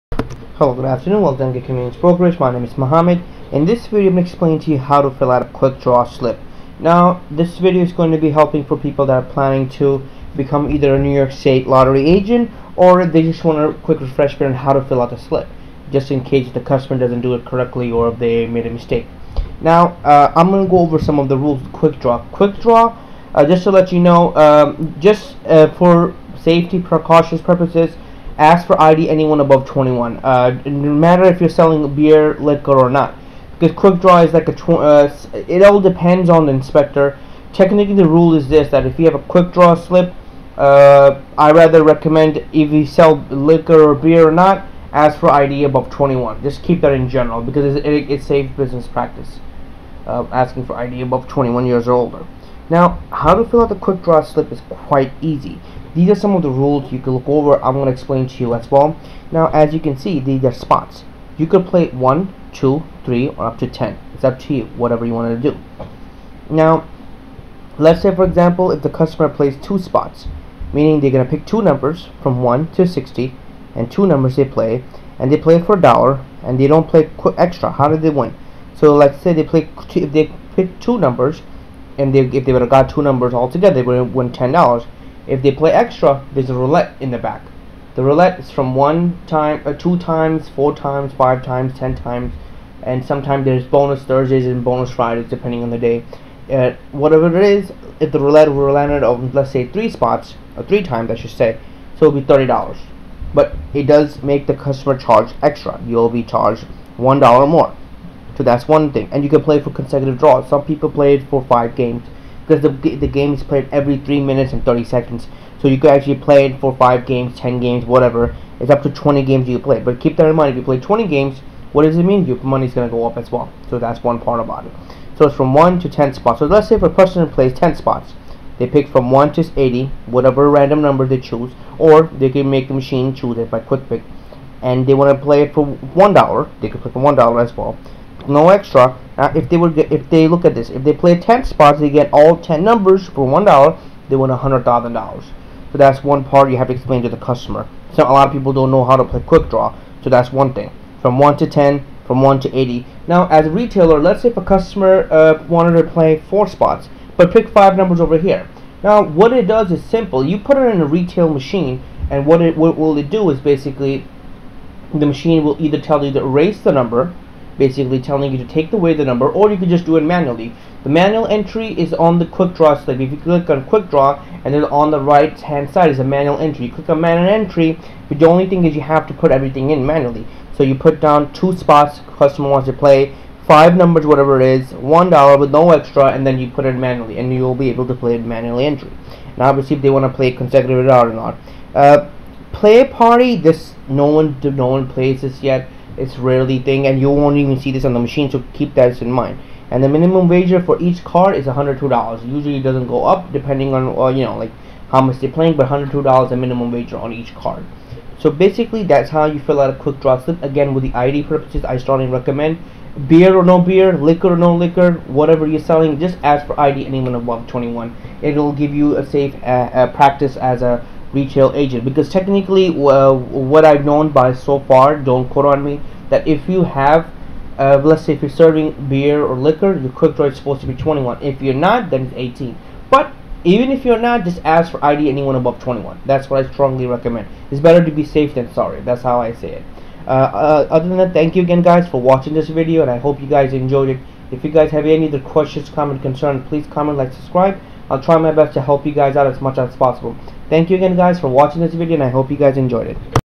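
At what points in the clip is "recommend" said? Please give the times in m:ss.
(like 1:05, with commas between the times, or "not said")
0:41, 3:32, 3:56.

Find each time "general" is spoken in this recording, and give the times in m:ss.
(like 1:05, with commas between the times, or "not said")
0:47.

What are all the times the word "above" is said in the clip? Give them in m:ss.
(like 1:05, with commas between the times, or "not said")
0:29, 0:45, 0:51, 3:37, 3:55.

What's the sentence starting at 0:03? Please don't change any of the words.
In this video, I'm going to explain to you how to fill out a quick draw slip.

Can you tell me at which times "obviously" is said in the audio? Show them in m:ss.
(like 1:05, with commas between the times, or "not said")
3:09.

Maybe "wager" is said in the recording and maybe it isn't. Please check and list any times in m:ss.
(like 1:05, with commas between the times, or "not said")
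3:20, 3:26.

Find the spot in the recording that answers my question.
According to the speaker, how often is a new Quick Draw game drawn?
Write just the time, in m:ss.
1:53.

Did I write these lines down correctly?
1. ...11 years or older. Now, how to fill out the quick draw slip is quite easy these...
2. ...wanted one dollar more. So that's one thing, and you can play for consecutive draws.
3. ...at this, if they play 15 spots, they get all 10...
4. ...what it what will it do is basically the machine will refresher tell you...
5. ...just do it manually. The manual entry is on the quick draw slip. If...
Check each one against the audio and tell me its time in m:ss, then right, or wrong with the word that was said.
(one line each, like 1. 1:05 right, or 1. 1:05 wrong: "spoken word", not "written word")
1. 0:51 wrong: "21", not "11"
2. 1:46 wrong: "charged", not "wanted"
3. 2:20 wrong: "10", not "15"
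4. 2:42 wrong: "either", not "refresher"
5. 2:49 right.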